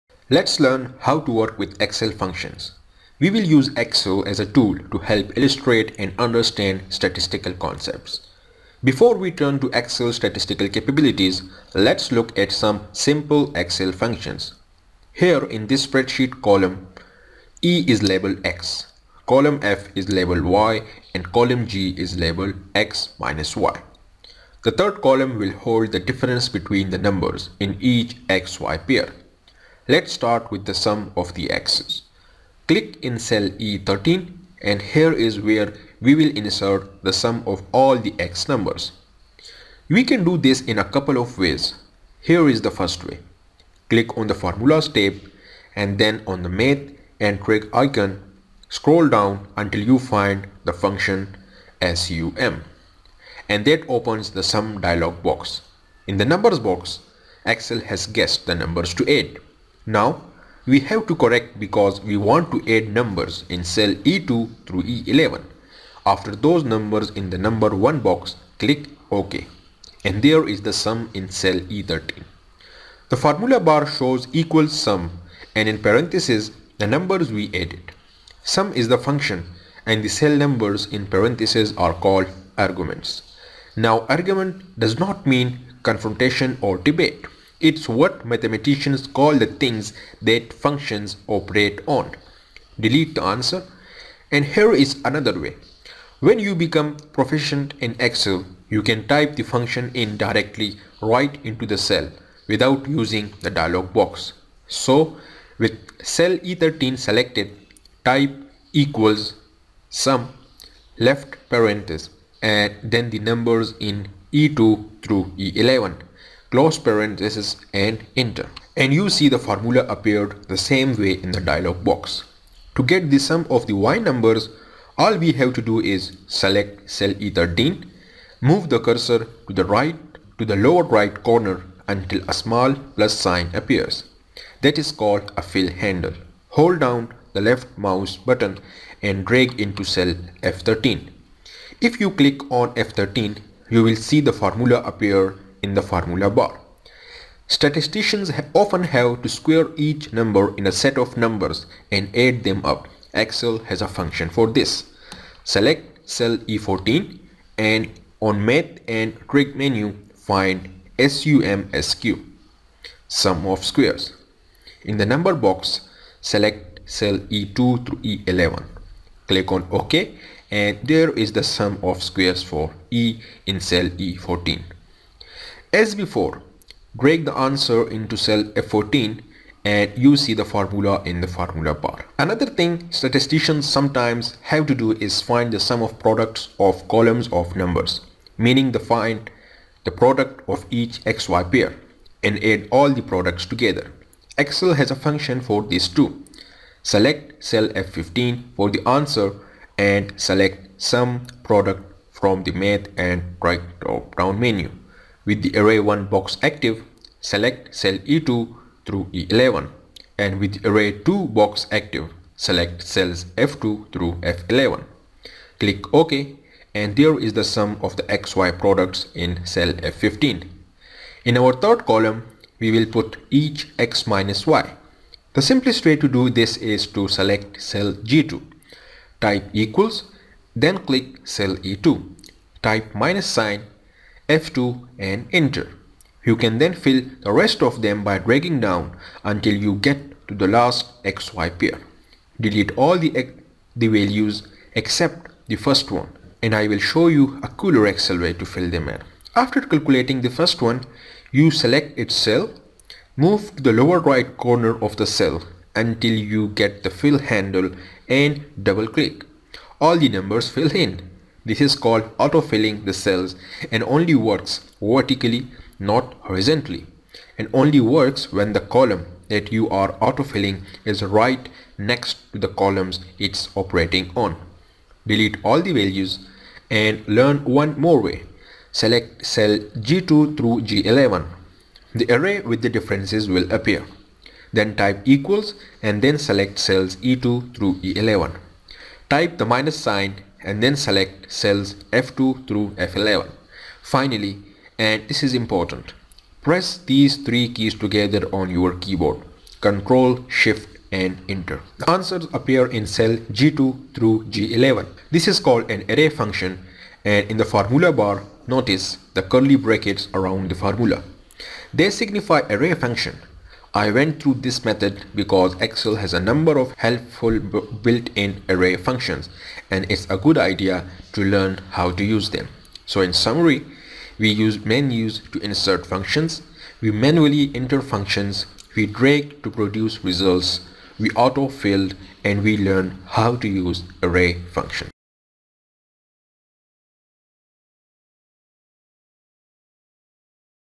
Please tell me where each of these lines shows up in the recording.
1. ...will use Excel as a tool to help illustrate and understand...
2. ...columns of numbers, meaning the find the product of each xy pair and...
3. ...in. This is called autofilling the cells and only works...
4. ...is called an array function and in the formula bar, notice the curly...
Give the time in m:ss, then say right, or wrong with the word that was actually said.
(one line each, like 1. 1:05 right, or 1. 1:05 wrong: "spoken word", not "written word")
1. 0:03 right
2. 3:06 right
3. 4:20 right
4. 5:05 right.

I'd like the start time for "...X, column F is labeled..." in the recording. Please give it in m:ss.
0:18.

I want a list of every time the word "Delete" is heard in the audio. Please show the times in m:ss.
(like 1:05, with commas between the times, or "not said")
1:32, 4:02, 4:35.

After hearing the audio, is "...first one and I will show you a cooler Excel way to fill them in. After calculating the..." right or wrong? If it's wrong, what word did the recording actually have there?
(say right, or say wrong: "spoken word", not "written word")
right.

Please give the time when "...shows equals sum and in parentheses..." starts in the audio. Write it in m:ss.
1:13.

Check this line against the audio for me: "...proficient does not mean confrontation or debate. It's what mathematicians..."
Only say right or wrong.
wrong.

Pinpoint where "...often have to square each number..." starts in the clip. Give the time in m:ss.
2:28.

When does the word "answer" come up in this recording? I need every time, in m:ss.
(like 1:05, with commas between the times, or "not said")
1:33, 2:57, 3:18, 5:01.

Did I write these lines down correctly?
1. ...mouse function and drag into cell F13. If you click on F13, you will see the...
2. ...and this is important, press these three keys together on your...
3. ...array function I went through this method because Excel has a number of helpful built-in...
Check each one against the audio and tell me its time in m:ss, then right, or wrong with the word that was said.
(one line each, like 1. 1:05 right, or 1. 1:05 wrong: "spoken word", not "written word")
1. 2:17 wrong: "button", not "function"
2. 4:54 right
3. 5:12 right.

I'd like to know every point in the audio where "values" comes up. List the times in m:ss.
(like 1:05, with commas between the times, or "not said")
4:03, 4:35.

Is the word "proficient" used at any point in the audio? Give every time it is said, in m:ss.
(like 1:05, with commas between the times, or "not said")
1:37.